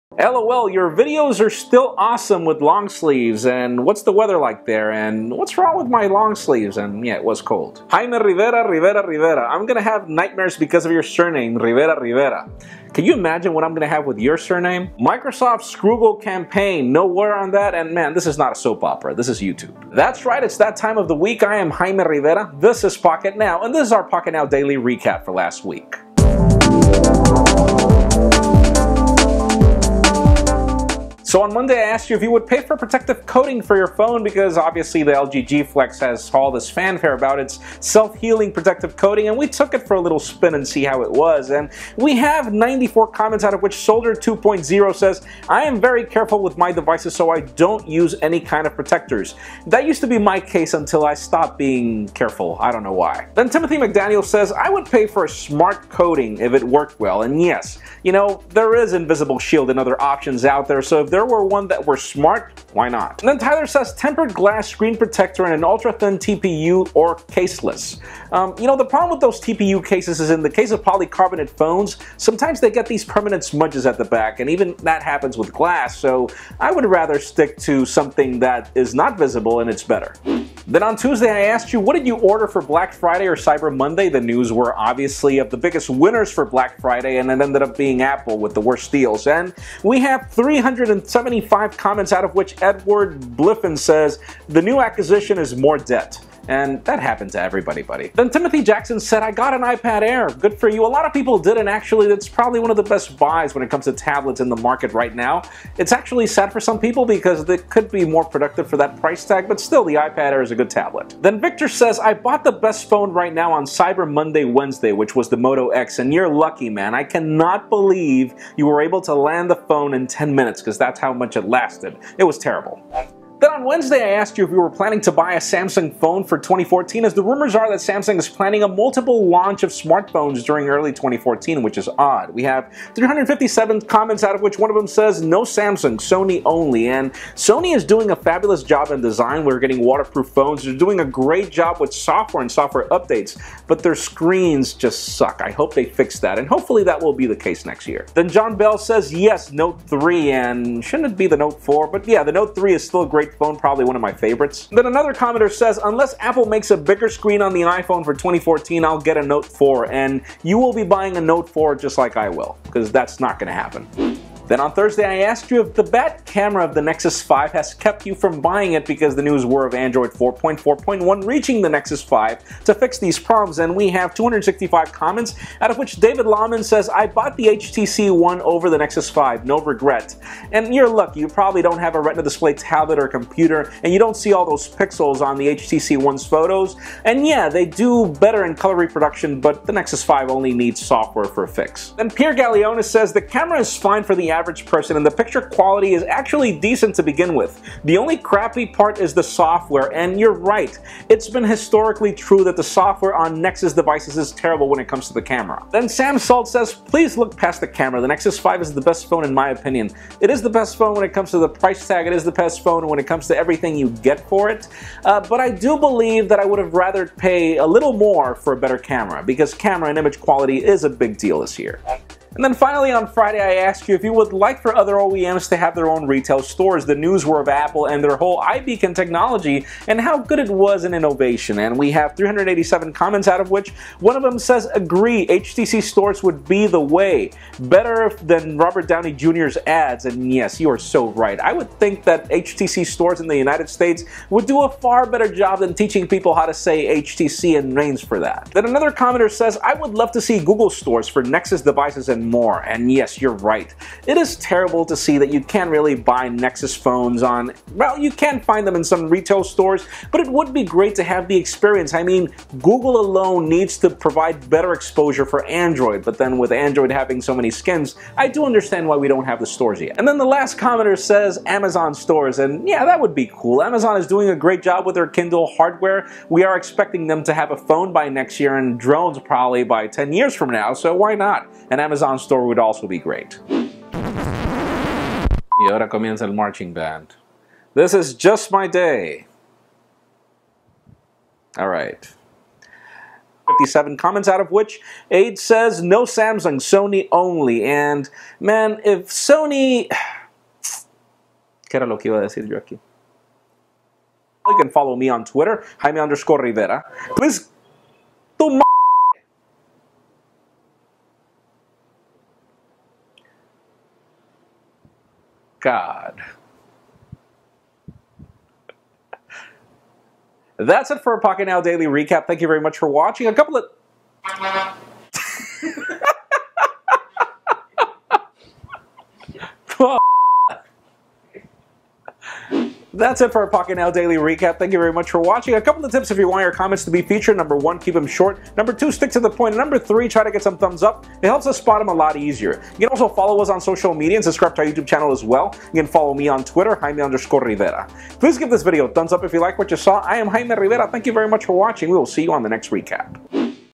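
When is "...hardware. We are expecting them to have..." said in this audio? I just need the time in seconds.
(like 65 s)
275 s.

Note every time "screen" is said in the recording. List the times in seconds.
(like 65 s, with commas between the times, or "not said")
64 s, 143 s, 157 s.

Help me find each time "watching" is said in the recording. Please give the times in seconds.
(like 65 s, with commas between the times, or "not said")
322 s, 335 s, 351 s.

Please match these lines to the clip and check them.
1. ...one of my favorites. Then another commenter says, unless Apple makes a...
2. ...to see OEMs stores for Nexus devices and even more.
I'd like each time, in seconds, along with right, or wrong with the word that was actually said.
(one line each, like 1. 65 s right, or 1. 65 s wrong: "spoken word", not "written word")
1. 153 s right
2. 250 s wrong: "Google", not "OEMs".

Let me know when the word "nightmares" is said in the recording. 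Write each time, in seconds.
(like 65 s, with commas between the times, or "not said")
10 s.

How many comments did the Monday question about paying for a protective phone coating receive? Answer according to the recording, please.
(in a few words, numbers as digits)
94.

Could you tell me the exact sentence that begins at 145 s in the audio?
I hope they fix that, and hopefully that will be the case next year.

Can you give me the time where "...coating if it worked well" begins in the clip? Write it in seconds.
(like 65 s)
55 s.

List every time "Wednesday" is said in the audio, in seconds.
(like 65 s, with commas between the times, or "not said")
114 s, 123 s.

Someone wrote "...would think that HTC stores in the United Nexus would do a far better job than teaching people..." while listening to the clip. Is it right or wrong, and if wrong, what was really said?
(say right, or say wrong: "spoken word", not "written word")
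wrong: "States", not "Nexus".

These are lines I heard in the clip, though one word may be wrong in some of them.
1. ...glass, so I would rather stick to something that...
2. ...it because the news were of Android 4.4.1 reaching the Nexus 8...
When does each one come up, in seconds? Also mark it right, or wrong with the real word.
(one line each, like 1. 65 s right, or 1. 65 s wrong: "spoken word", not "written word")
1. 75 s right
2. 168 s wrong: "5", not "8".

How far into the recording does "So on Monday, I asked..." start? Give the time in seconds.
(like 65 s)
31 s.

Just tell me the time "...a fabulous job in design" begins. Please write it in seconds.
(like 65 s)
138 s.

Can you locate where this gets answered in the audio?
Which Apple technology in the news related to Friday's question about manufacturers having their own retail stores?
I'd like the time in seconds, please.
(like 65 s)
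228 s.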